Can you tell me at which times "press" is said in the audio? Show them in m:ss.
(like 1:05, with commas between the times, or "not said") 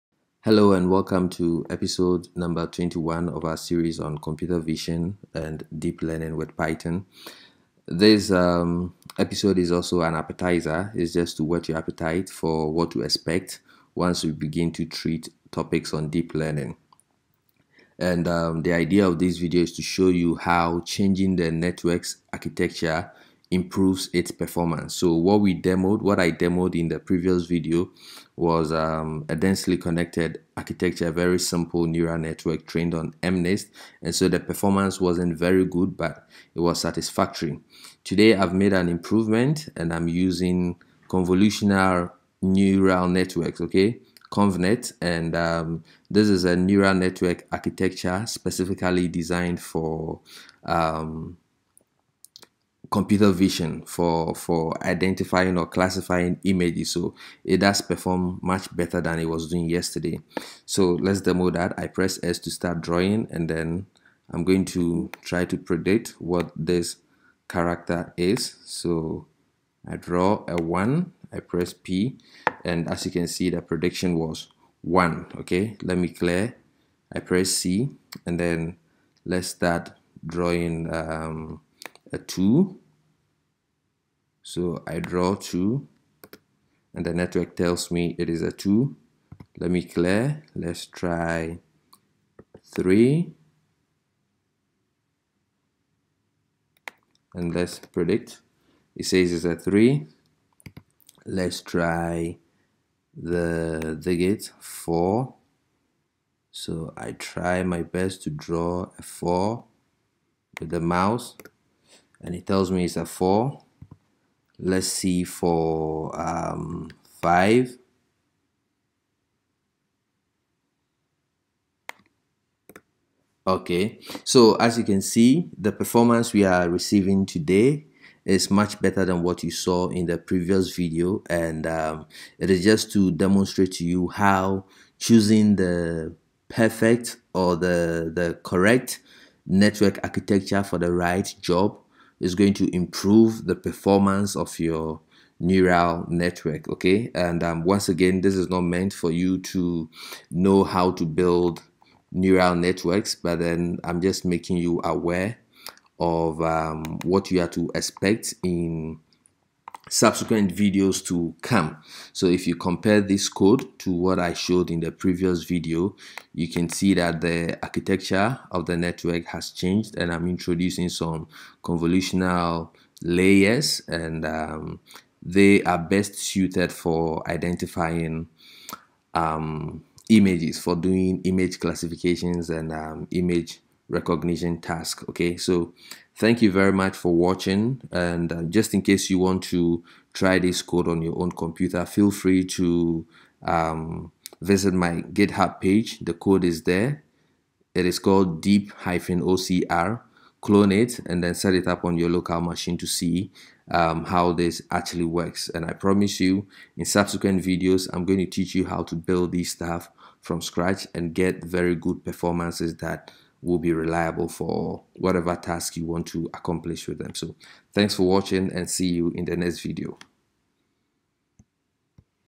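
1:01, 1:11, 1:17.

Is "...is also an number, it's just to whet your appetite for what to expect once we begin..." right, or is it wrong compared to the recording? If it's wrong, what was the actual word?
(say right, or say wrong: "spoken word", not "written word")
wrong: "appetizer", not "number".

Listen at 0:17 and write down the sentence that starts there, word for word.
And um, the idea of this video is to show you how changing the network's architecture improves its performance.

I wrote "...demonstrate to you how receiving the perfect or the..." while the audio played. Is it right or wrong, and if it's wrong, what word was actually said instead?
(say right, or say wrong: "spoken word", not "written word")
wrong: "choosing", not "receiving".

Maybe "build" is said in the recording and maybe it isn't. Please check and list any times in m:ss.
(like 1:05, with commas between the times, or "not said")
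2:31, 3:28.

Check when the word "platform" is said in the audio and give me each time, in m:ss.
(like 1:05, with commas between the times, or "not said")
not said.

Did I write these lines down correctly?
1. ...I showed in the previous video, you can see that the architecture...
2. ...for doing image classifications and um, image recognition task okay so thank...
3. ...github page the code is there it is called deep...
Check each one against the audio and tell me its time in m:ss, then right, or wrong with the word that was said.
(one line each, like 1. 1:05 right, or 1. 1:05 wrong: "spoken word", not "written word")
1. 2:44 right
2. 3:00 right
3. 3:15 right.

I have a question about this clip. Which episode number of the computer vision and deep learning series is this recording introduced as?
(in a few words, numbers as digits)
21.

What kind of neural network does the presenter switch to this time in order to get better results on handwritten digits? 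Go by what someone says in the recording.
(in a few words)
Convolutional neural networks.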